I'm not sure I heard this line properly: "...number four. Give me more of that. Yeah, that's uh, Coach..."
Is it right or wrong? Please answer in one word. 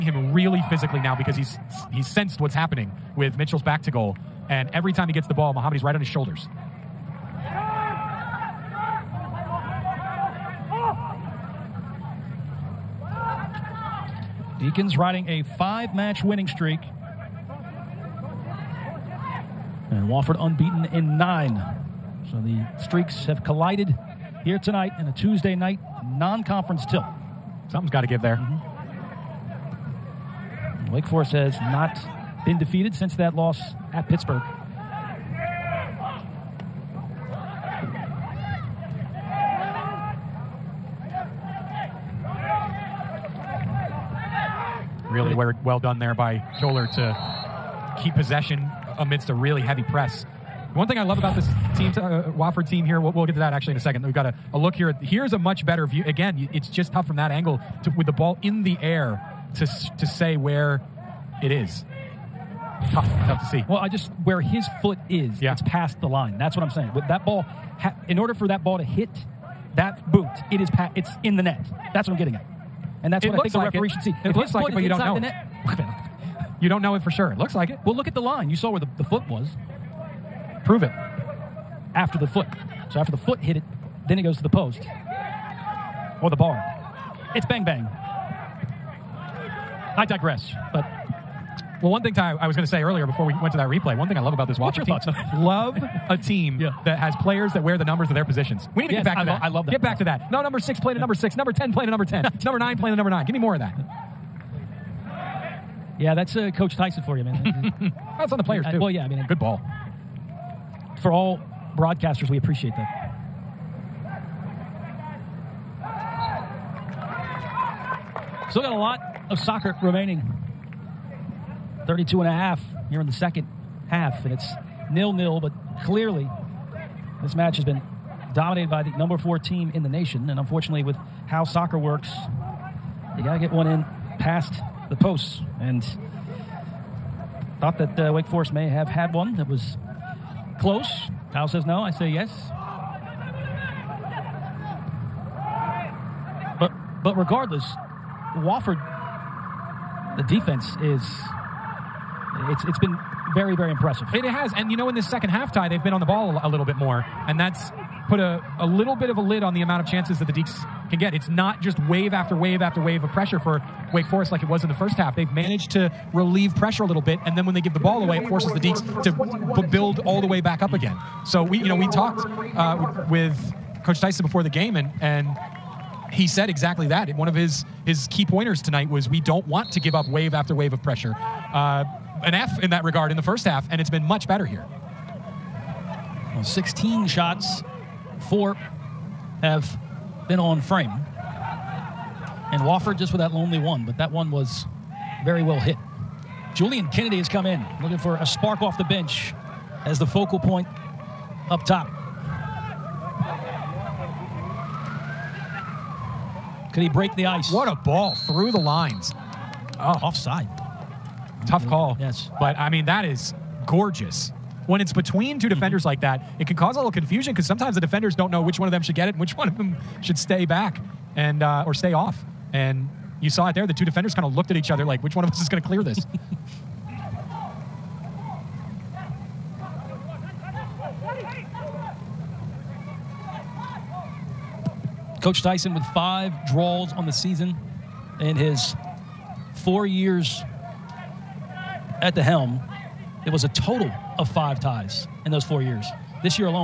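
wrong.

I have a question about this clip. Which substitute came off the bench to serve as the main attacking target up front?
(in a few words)
Julian Kennedy.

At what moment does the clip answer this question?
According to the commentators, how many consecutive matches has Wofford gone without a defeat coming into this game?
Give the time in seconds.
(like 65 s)
20 s.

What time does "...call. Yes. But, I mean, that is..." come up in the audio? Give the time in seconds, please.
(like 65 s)
211 s.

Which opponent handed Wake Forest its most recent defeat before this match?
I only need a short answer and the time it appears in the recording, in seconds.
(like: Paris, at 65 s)
Pittsburgh, at 34 s.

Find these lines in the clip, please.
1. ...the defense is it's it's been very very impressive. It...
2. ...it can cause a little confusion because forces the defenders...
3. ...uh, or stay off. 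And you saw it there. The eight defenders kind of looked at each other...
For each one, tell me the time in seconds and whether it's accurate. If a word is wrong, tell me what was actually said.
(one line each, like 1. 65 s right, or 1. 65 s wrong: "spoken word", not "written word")
1. 150 s right
2. 216 s wrong: "sometimes", not "forces"
3. 221 s wrong: "two", not "eight".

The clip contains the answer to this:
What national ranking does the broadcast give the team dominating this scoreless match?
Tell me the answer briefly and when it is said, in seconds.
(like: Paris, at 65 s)
4, at 128 s.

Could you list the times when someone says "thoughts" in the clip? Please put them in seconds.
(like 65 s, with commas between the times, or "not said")
94 s, 137 s.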